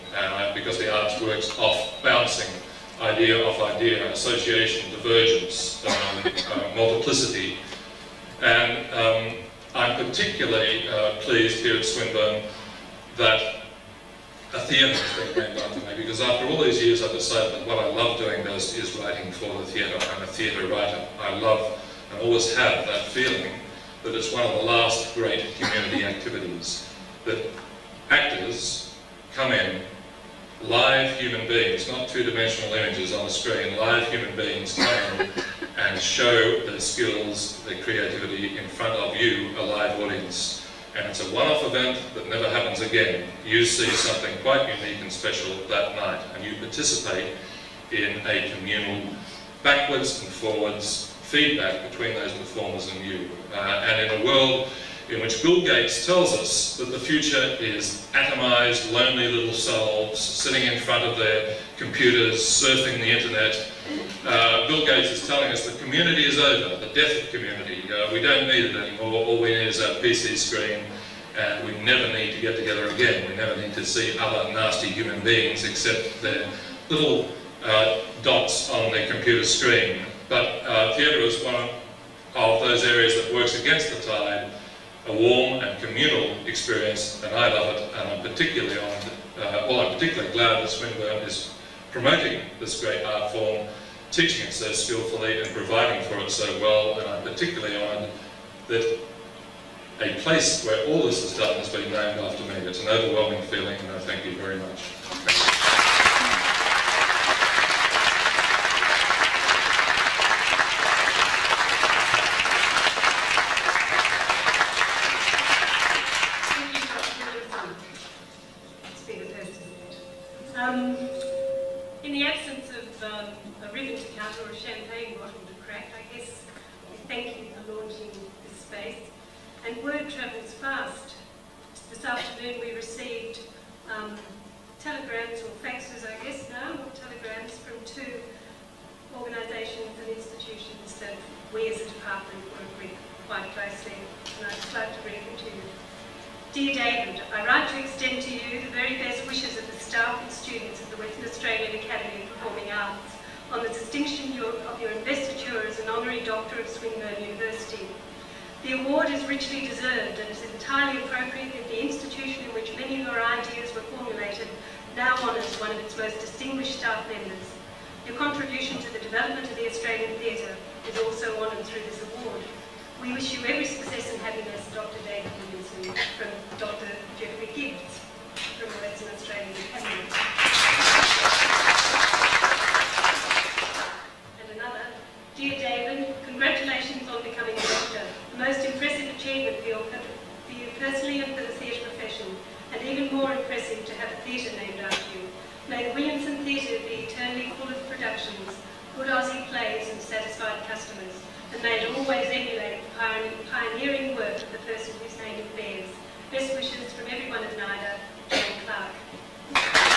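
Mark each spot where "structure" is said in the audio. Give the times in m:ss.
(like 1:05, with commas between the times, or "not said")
not said.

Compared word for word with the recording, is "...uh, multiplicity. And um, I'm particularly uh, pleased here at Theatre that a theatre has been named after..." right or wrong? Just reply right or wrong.
wrong.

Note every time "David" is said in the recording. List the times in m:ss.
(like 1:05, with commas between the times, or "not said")
2:26, 2:55, 3:05.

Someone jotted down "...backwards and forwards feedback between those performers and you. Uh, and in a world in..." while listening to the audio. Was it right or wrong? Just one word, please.
right.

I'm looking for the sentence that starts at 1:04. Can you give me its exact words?
Uh, Bill Gates is telling us the community is over, the death of community.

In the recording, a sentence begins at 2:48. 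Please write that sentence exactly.
Your contribution to the development of the Australian theatre is also honoured through this award.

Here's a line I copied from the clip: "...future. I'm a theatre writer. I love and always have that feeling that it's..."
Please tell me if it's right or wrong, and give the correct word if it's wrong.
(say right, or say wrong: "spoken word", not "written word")
wrong: "theatre", not "future".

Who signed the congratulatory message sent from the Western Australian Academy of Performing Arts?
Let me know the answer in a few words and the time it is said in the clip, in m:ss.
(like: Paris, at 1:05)
Geoffrey Gibbs, at 2:57.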